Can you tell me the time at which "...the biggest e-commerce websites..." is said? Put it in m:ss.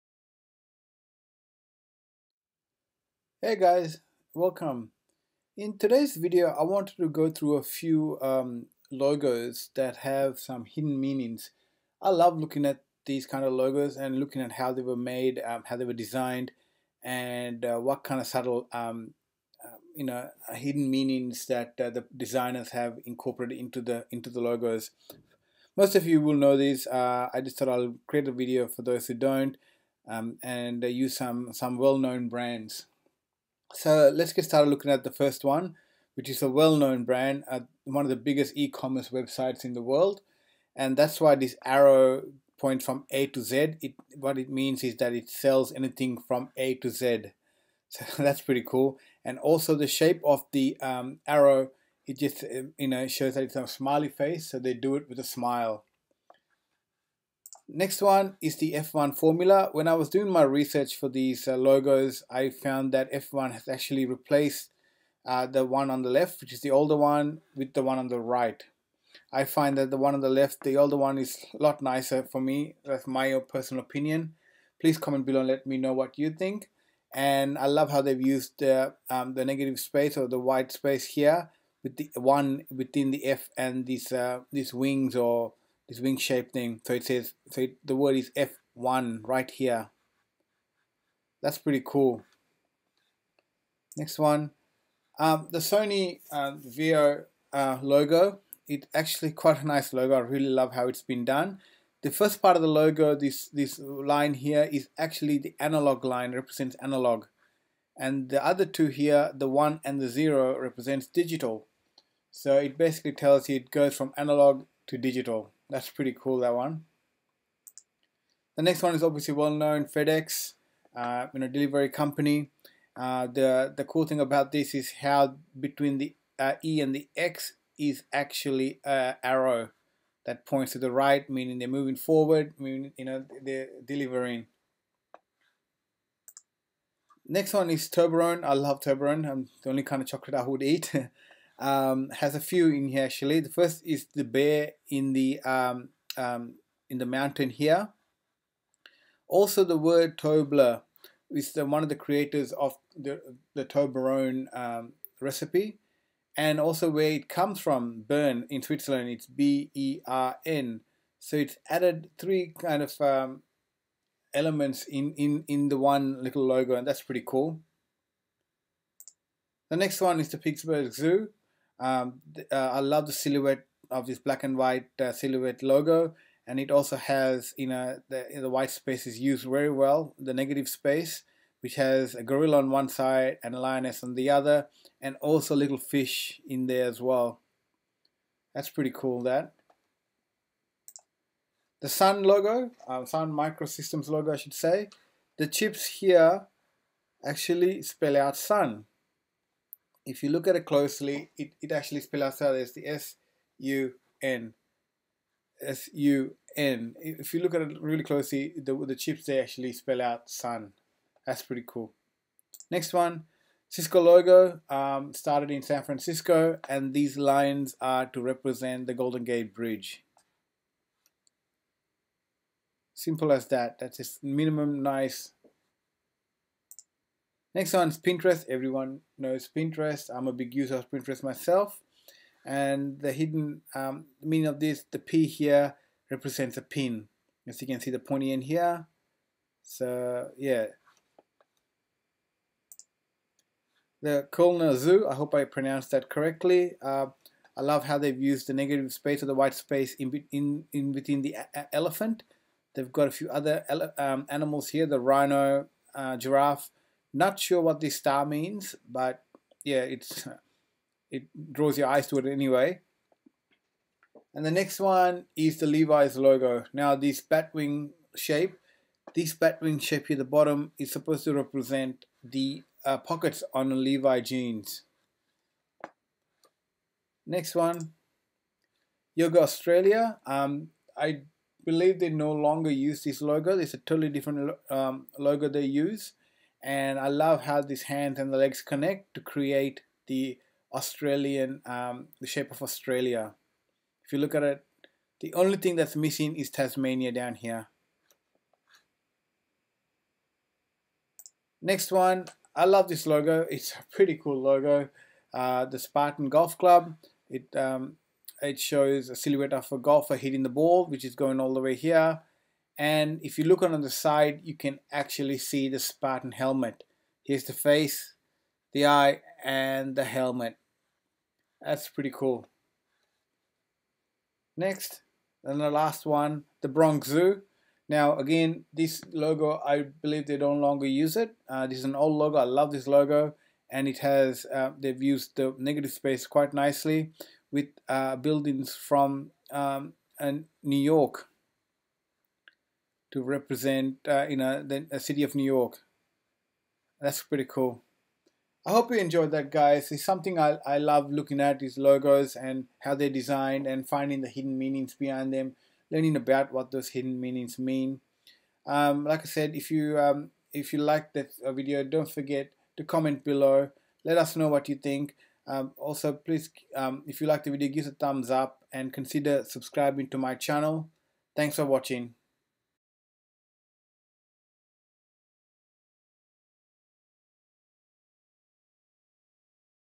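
0:38.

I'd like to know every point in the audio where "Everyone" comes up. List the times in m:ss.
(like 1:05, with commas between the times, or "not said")
3:48.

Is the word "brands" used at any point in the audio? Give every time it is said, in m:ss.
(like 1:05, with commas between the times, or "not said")
0:32, 0:37.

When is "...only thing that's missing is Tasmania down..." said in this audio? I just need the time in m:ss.
4:55.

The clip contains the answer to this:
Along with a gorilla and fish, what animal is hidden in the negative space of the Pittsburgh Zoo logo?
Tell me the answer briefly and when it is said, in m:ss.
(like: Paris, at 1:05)
lioness, at 3:03.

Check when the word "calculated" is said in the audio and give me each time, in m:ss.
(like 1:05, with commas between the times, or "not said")
not said.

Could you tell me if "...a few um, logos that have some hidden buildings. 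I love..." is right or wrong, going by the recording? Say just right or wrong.
wrong.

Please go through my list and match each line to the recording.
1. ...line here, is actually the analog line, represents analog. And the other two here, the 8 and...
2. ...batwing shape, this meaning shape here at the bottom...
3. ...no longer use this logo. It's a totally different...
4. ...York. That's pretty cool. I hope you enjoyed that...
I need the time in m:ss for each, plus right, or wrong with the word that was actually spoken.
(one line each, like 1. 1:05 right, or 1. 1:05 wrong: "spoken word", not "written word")
1. 1:43 wrong: "1", not "8"
2. 4:27 wrong: "batwing", not "meaning"
3. 4:42 right
4. 5:45 right.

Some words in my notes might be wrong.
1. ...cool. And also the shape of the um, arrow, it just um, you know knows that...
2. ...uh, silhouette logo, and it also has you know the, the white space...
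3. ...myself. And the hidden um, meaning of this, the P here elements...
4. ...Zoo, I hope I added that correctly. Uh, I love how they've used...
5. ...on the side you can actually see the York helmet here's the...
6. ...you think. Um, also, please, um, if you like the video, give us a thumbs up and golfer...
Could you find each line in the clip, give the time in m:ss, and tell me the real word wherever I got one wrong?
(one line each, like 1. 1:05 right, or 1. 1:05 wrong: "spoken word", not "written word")
1. 0:48 wrong: "shows", not "knows"
2. 2:55 right
3. 3:51 wrong: "represents", not "elements"
4. 4:04 wrong: "pronounced", not "added"
5. 5:13 wrong: "Spartan", not "York"
6. 6:04 wrong: "consider", not "golfer".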